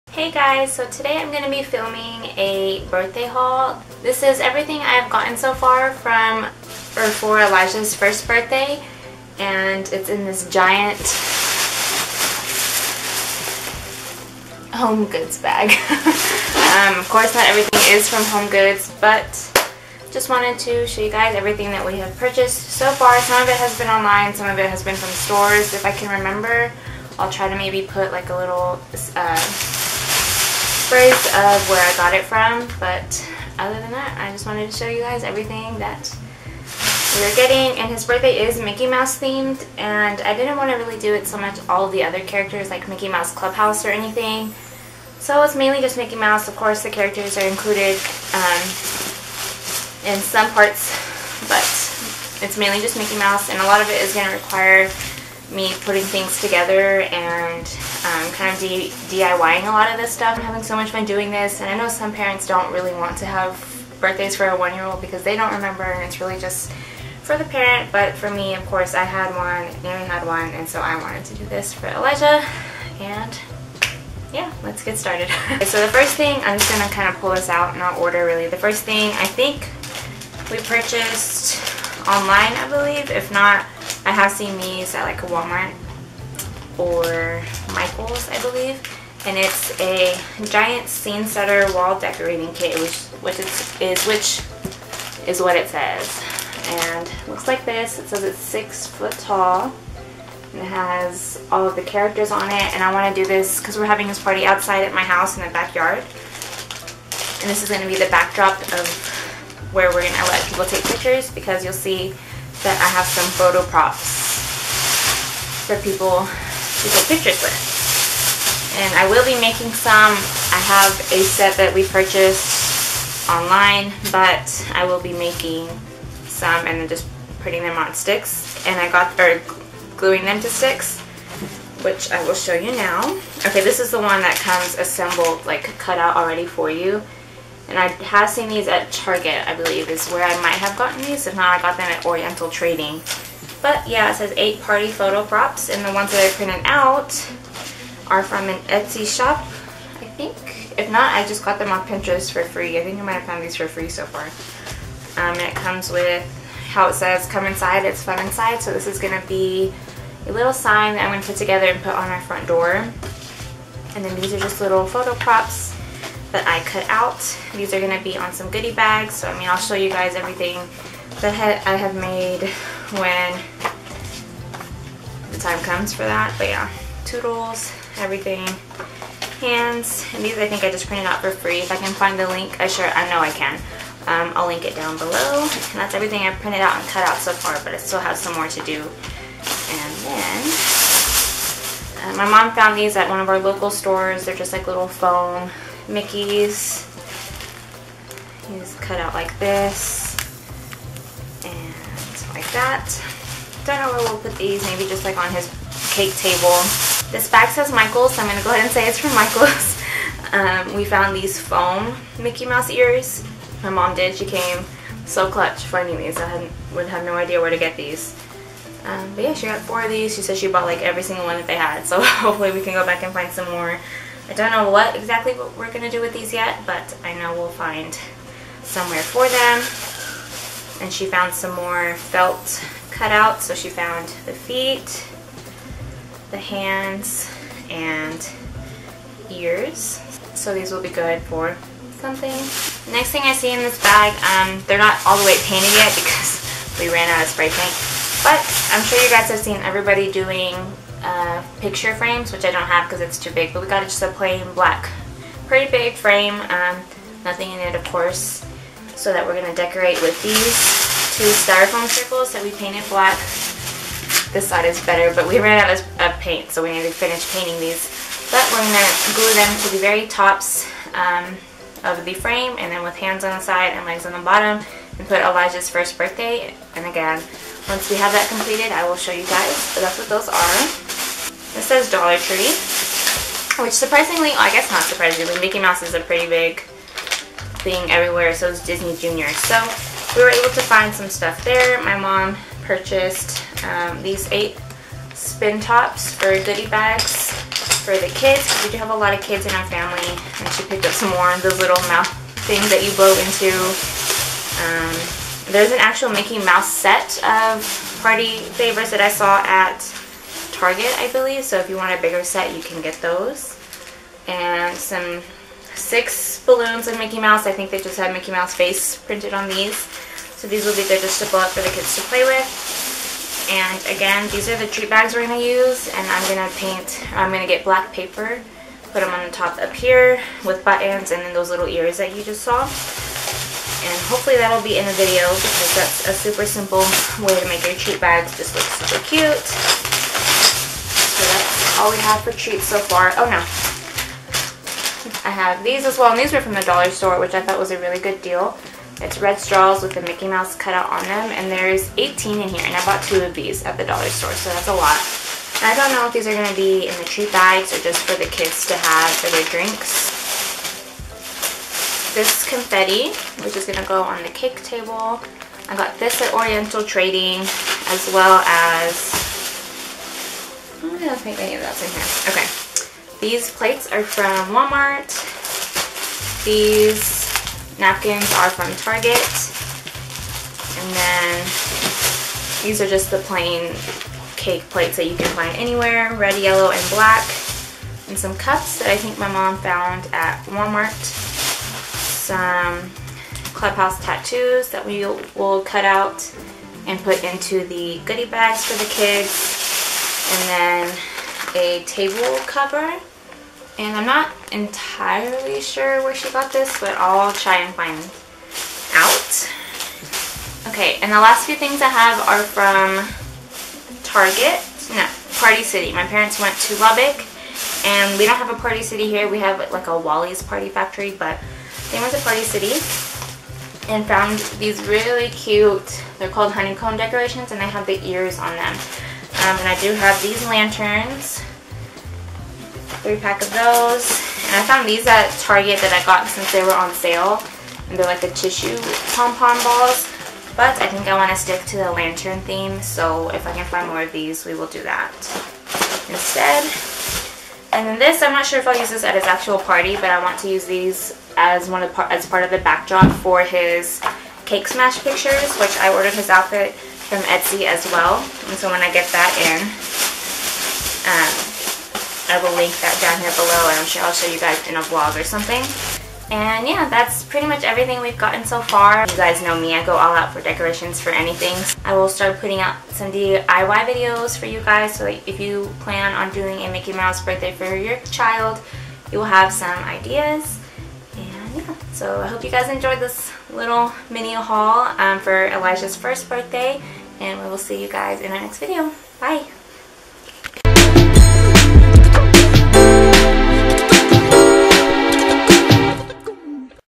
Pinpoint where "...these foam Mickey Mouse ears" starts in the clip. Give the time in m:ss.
3:31.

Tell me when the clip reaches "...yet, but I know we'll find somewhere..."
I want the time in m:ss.
3:46.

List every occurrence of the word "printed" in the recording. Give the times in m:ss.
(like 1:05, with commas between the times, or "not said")
2:26, 3:00, 3:06, 5:18.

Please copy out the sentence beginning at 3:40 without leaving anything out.
She said she bought like every single one that they had.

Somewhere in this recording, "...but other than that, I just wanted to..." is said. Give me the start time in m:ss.
0:32.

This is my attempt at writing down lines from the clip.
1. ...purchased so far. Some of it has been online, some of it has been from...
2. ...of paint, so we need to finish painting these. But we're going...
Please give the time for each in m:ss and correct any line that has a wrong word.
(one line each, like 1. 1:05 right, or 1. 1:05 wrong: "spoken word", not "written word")
1. 0:22 right
2. 4:25 right.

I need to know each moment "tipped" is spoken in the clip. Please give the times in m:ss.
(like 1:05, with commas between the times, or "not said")
not said.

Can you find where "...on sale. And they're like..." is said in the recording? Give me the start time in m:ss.
7:16.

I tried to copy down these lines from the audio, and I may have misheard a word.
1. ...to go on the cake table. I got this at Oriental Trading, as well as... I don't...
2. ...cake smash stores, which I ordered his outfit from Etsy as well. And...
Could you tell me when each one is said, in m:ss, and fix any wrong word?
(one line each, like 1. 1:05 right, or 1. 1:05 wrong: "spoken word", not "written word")
1. 6:03 right
2. 7:34 wrong: "pictures", not "stores".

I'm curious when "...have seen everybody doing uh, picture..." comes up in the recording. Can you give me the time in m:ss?
4:09.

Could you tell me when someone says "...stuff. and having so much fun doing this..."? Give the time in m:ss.
1:00.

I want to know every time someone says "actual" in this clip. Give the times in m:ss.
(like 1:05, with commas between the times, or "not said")
5:05, 7:29.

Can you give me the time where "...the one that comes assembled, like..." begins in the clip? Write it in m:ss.
2:13.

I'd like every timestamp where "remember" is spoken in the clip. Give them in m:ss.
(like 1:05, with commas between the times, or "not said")
0:26, 1:05.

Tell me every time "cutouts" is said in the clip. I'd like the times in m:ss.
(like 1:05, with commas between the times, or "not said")
3:52, 5:50.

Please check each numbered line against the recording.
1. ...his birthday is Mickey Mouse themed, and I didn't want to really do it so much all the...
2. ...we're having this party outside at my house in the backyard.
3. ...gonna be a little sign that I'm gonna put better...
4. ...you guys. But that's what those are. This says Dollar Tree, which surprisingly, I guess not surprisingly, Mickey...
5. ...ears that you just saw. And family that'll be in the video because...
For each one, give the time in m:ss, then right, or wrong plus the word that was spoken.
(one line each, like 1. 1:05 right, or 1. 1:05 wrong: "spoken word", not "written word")
1. 0:37 right
2. 1:43 right
3. 2:38 wrong: "together", not "better"
4. 4:39 right
5. 5:31 wrong: "hopefully", not "family".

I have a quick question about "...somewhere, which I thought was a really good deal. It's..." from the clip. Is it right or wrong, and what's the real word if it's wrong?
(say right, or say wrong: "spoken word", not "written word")
wrong: "store", not "somewhere".